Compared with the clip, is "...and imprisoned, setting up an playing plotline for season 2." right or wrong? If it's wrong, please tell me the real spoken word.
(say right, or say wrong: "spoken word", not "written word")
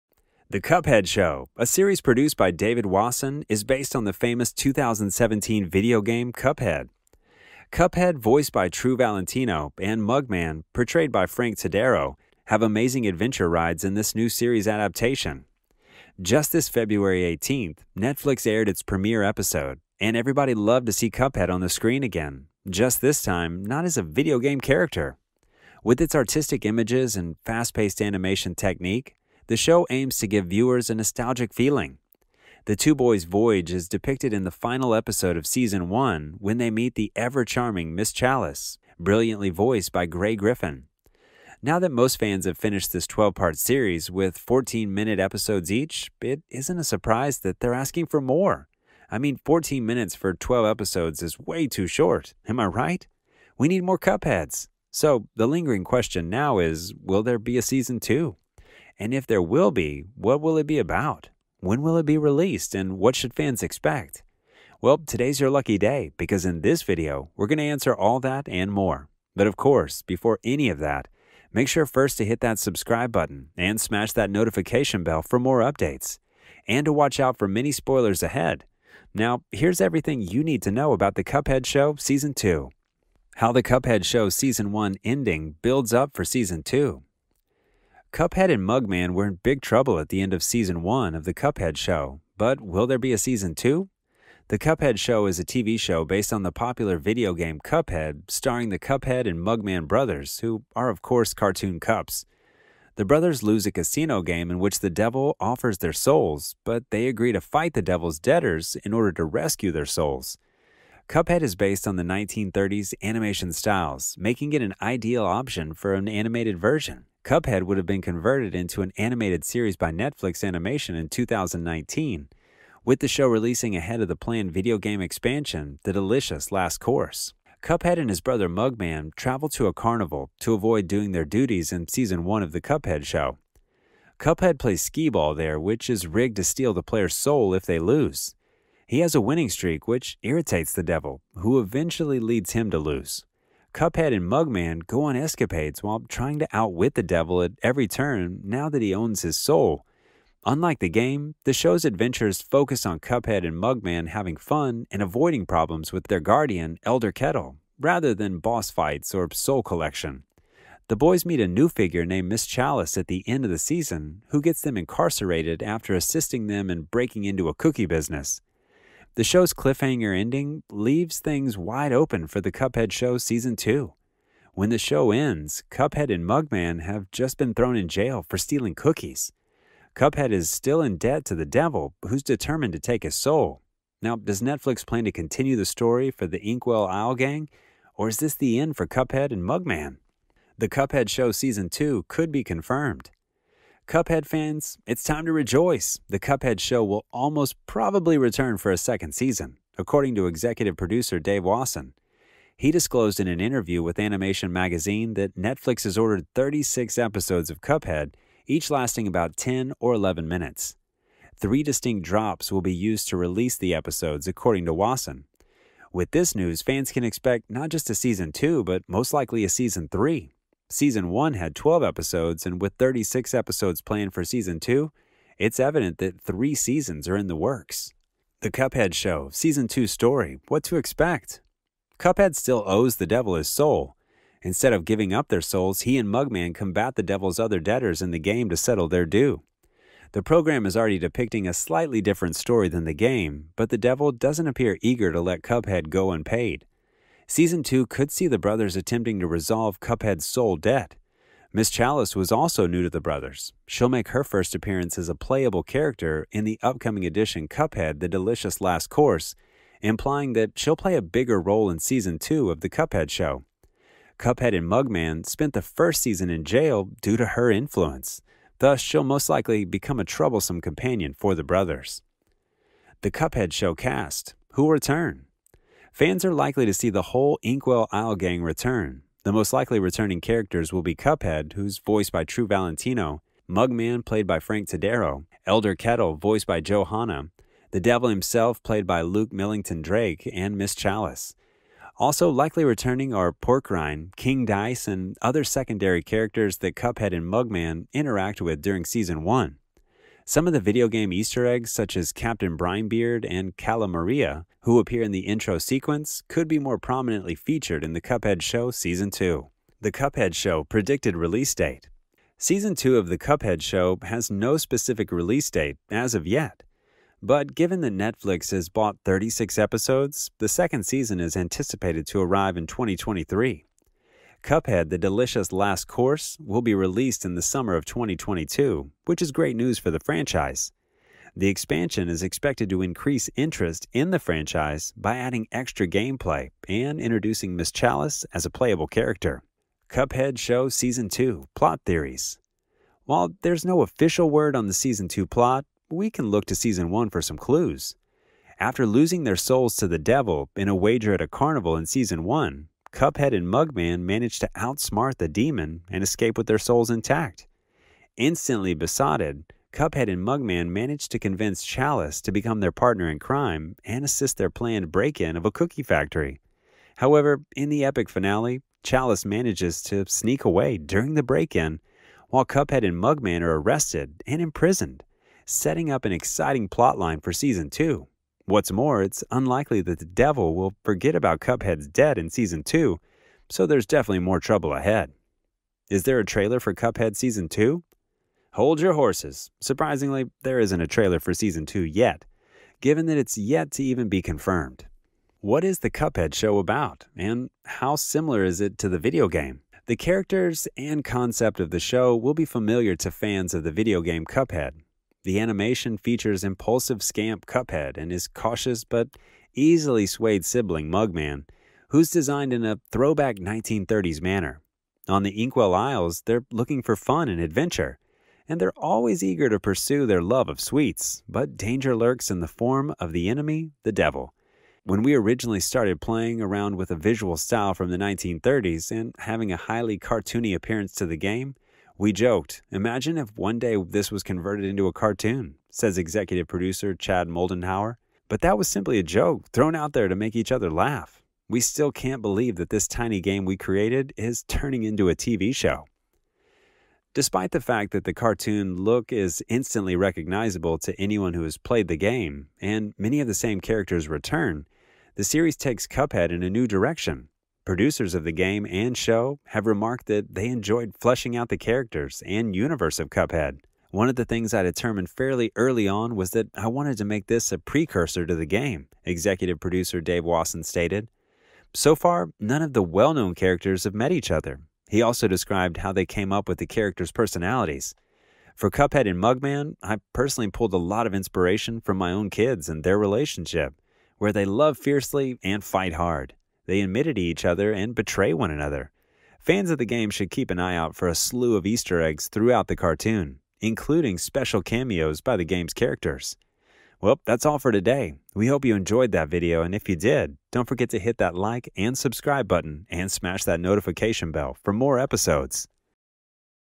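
wrong: "exciting", not "playing".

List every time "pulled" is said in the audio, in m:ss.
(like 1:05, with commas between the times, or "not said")
8:00.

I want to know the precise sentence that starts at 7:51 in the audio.
So far, none of the well known characters have met each other.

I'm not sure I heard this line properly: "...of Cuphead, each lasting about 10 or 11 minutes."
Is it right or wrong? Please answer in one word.
right.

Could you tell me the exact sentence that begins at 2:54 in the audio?
When the show ends, Cuphead and Mugman have just been thrown in jail for stealing cookies.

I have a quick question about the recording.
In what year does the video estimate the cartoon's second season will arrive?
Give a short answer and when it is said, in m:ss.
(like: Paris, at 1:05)
2023, at 5:22.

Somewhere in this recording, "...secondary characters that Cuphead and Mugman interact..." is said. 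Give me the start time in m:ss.
4:55.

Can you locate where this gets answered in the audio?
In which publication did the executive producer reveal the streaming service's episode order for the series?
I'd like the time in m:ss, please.
3:23.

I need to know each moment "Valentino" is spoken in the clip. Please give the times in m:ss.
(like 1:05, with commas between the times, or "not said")
0:08, 4:42.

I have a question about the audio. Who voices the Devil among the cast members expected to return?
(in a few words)
Luke Millington Drake.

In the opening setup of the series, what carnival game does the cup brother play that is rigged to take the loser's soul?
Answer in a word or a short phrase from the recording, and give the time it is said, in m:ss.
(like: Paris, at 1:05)
skee ball, at 2:14.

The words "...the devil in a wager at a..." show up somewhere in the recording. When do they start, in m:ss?
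5:49.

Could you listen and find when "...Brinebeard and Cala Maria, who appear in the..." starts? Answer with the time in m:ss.
5:02.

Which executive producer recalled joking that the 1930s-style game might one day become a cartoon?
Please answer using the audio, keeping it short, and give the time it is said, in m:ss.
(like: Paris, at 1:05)
Chad Moldenhauer, at 7:16.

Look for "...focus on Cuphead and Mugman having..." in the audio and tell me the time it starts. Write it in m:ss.
2:32.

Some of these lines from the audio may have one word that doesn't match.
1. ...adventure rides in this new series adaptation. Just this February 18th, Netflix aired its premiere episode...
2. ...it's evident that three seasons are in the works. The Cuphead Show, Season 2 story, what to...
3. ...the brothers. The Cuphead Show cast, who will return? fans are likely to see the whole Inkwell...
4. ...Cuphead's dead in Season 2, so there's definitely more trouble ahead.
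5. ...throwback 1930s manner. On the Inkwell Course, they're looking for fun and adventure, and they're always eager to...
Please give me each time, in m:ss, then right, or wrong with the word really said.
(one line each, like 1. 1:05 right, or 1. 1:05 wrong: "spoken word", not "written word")
1. 0:13 right
2. 3:45 right
3. 4:31 right
4. 6:21 right
5. 6:52 wrong: "Isles", not "Course".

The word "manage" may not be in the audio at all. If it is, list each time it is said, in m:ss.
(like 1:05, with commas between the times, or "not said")
5:54, 6:00, 6:09.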